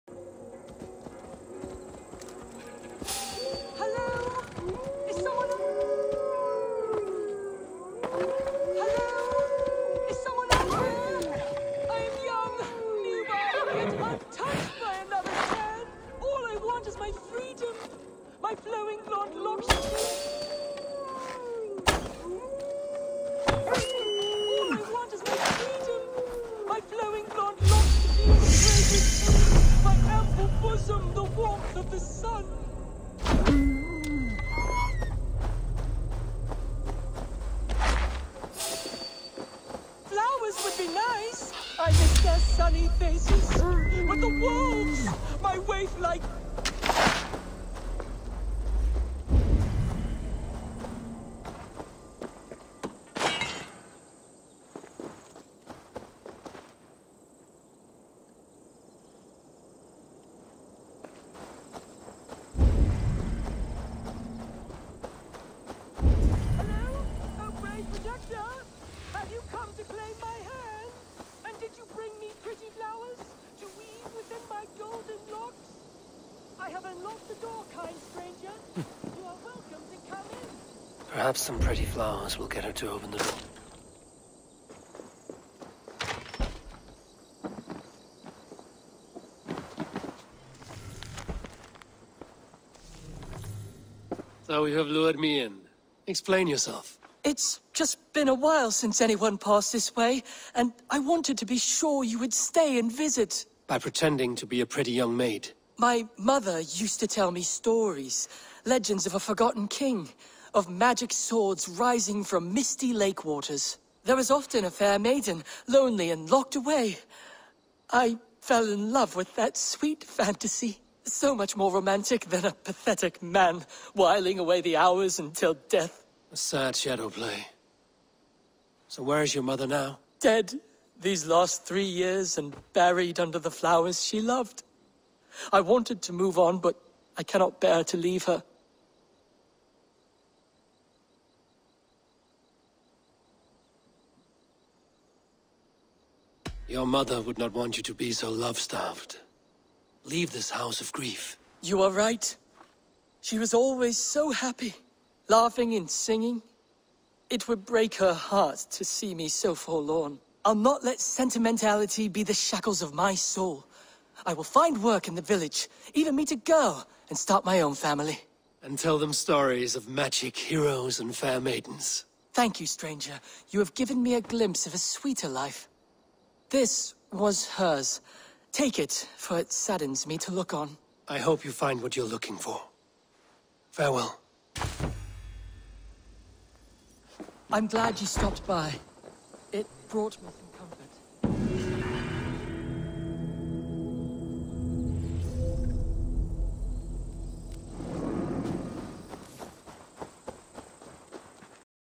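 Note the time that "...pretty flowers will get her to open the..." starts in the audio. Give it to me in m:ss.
1:21.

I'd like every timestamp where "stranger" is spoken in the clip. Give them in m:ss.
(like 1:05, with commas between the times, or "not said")
1:18, 2:52.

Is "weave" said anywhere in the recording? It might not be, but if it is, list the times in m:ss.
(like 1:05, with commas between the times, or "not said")
1:13.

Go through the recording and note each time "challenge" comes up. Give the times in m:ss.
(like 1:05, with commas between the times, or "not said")
not said.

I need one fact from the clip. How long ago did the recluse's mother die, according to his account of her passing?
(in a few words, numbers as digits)
3 years.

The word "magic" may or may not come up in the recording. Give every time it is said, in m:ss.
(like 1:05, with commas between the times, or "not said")
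1:50, 2:49.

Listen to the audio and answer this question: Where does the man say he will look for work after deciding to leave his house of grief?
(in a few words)
The village.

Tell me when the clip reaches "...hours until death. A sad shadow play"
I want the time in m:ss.
2:04.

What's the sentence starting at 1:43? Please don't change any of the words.
By pretending to be a pretty young maid?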